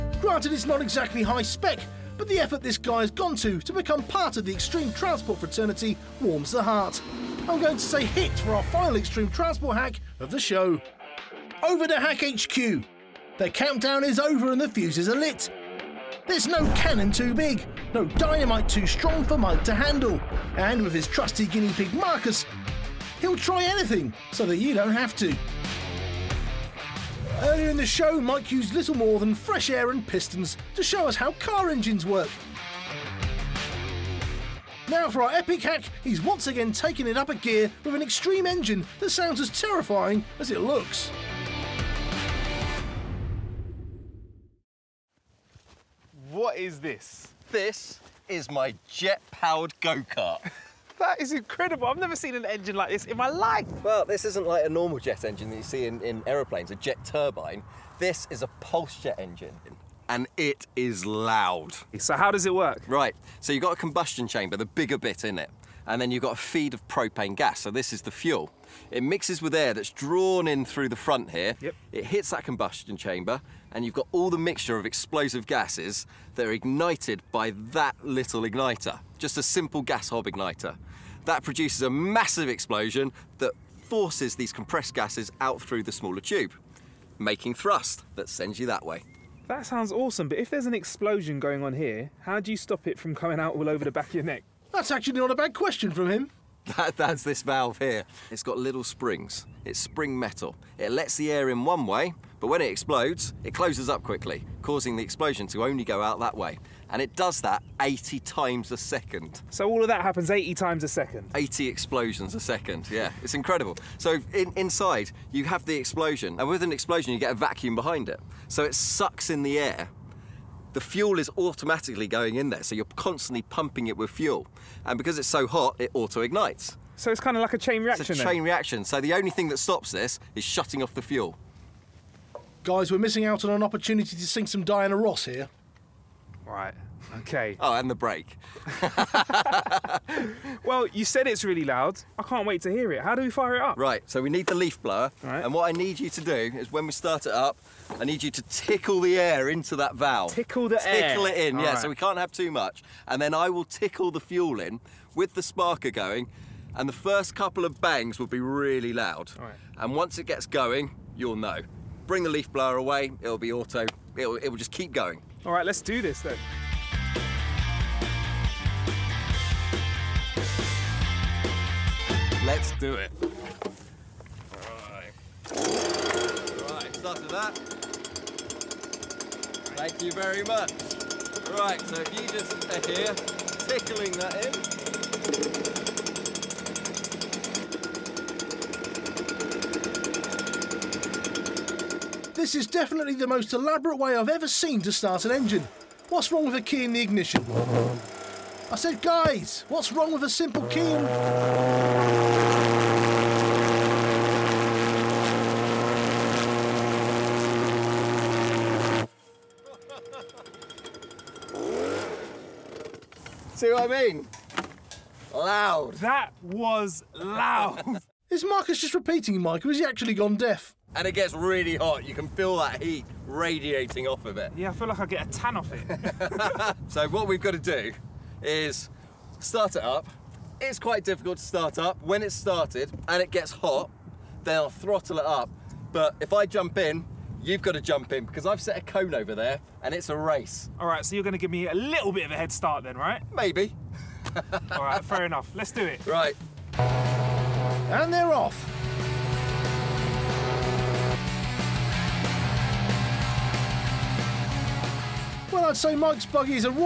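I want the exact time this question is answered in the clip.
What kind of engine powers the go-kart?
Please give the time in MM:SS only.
00:58.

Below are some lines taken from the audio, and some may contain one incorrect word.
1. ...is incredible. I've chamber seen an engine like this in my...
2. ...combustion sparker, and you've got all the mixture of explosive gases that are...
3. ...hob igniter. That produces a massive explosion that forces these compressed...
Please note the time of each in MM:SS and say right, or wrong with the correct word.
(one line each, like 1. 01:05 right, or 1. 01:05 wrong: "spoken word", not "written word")
1. 00:51 wrong: "never", not "chamber"
2. 01:12 wrong: "chamber", not "sparker"
3. 01:20 right.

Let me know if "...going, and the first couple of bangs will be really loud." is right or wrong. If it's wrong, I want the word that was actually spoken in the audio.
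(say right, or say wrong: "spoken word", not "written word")
right.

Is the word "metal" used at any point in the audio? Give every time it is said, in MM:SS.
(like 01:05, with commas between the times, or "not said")
01:40.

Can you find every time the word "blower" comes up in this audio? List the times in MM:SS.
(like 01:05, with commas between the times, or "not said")
02:24, 02:42.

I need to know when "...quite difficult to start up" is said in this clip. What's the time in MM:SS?
03:50.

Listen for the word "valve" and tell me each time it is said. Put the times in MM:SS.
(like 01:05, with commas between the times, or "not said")
01:37, 02:29.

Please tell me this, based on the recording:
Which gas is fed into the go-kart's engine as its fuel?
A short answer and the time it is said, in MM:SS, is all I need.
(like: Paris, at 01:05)
propane, at 01:06.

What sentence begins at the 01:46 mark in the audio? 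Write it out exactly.
And it does that 80 times a second.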